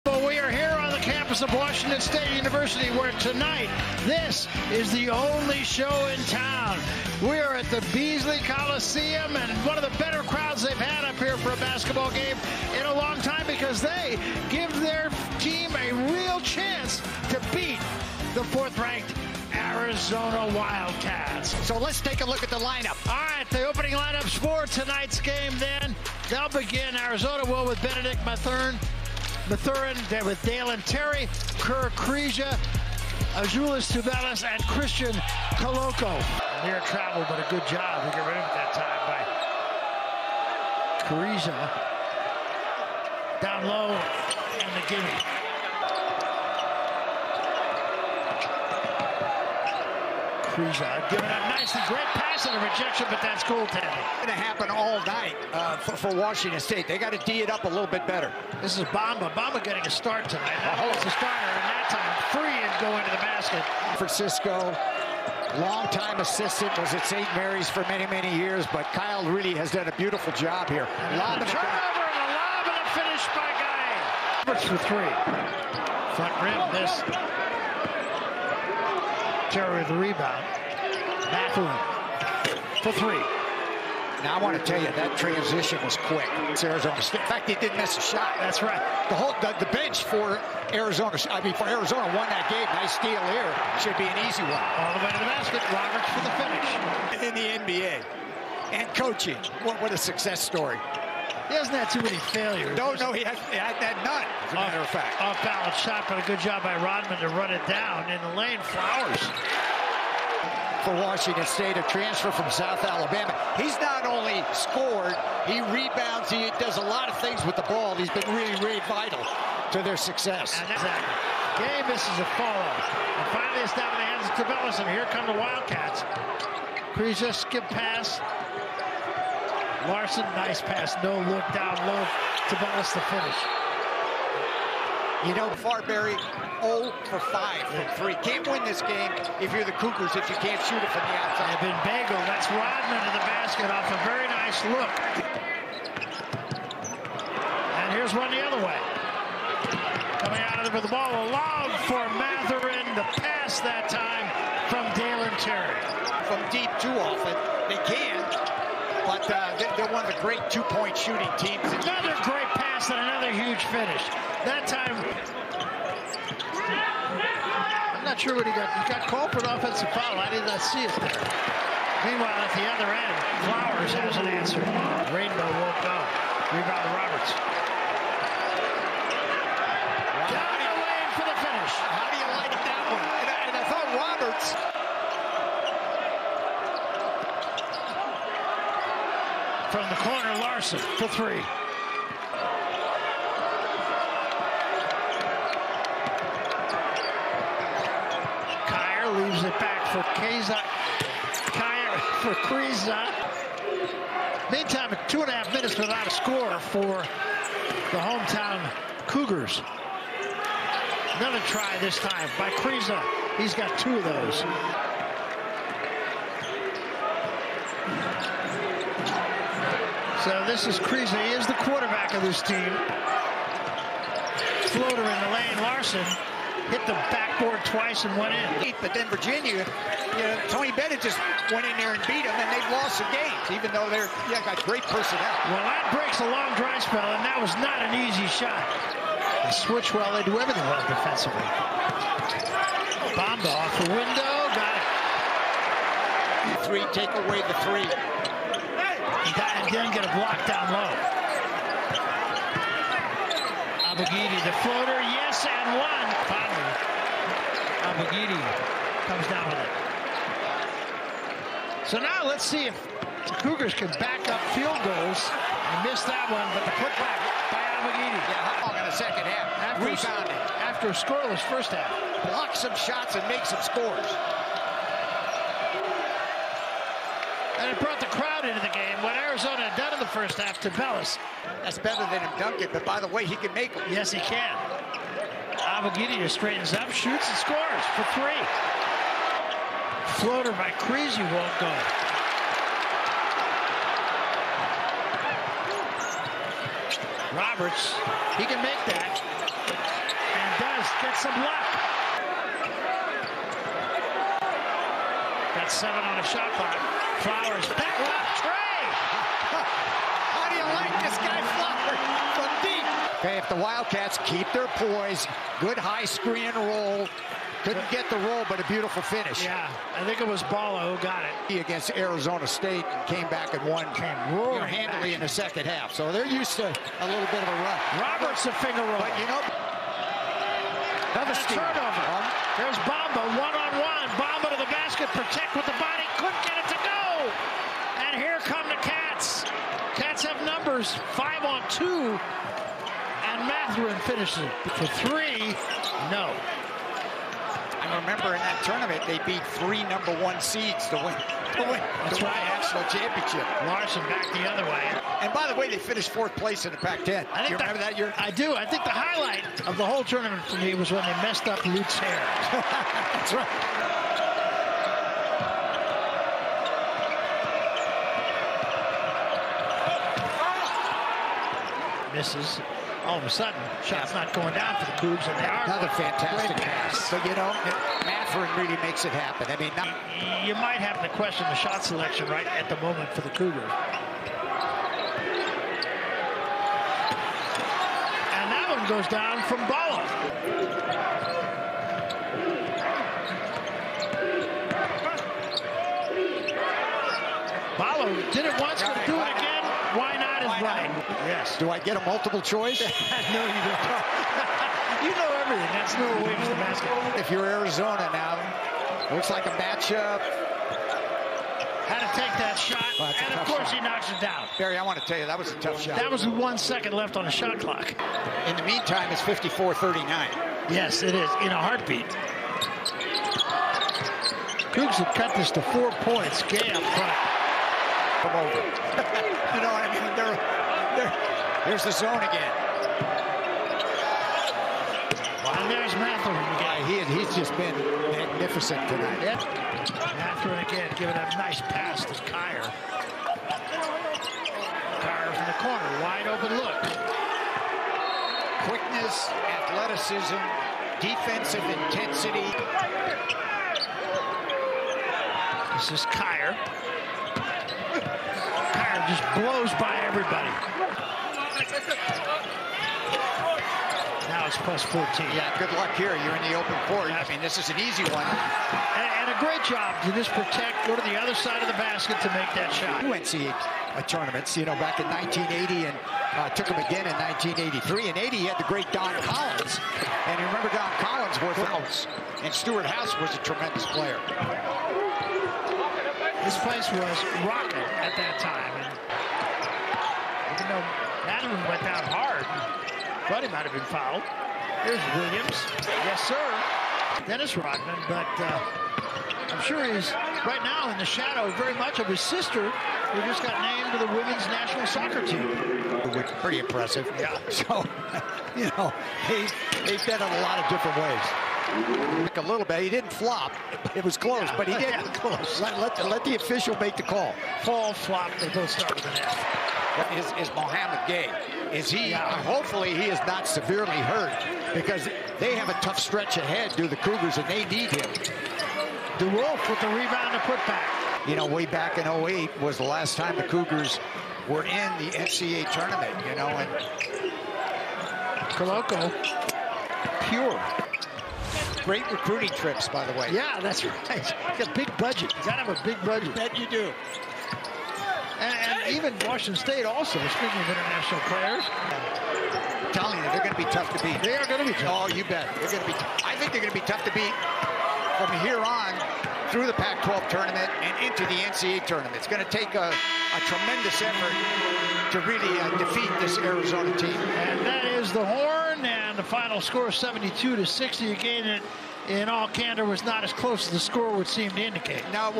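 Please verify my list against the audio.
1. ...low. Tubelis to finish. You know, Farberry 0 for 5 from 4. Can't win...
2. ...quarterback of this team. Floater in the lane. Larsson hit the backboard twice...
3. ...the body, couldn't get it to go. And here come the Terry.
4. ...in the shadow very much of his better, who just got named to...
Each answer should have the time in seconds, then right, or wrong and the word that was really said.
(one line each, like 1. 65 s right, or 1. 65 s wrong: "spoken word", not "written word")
1. 131 s wrong: "3", not "4"
2. 221 s right
3. 335 s wrong: "Cats", not "Terry"
4. 500 s wrong: "sister", not "better".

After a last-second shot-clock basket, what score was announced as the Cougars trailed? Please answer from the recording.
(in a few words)
54-39.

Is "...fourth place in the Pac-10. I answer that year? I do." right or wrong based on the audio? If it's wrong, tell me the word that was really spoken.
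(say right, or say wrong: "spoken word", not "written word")
wrong: "remember", not "answer".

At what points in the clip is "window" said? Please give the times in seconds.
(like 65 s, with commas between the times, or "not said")
243 s.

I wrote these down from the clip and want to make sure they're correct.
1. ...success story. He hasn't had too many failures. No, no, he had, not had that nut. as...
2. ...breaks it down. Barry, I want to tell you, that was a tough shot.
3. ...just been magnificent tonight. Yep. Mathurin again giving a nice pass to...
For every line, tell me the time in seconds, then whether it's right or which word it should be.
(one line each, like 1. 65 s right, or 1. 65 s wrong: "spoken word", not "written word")
1. 99 s right
2. 413 s wrong: "knocks", not "breaks"
3. 437 s right.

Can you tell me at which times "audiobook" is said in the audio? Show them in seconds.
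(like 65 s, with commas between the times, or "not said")
not said.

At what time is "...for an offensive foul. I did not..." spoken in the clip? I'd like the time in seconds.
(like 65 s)
169 s.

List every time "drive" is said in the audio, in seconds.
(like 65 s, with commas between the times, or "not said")
236 s.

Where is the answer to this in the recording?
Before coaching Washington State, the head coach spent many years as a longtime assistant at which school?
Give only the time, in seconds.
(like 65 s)
67 s.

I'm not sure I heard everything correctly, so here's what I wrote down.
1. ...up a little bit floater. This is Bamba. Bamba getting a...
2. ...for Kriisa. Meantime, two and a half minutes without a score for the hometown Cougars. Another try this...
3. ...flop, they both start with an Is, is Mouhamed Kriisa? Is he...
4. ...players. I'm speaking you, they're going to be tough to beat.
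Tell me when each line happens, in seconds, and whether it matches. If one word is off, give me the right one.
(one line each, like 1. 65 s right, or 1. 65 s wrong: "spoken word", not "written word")
1. 57 s wrong: "better", not "floater"
2. 202 s right
3. 517 s wrong: "Gueye", not "Kriisa"
4. 551 s wrong: "telling", not "speaking".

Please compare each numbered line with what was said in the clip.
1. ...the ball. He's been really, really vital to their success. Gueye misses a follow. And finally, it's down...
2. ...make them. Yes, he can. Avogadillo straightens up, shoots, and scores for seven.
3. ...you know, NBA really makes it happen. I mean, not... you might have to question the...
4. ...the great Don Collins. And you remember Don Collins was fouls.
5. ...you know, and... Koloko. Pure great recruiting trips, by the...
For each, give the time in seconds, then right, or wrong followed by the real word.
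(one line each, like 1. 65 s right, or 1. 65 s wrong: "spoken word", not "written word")
1. 117 s right
2. 283 s wrong: "three", not "seven"
3. 377 s wrong: "Mathurin", not "NBA"
4. 478 s right
5. 536 s right.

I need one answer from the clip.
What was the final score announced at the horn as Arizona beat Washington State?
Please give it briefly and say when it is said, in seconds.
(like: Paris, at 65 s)
72-60, at 569 s.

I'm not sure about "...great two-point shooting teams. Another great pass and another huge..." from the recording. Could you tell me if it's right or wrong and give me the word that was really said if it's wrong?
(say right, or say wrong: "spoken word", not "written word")
right.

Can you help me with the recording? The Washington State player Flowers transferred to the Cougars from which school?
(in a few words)
South Alabama.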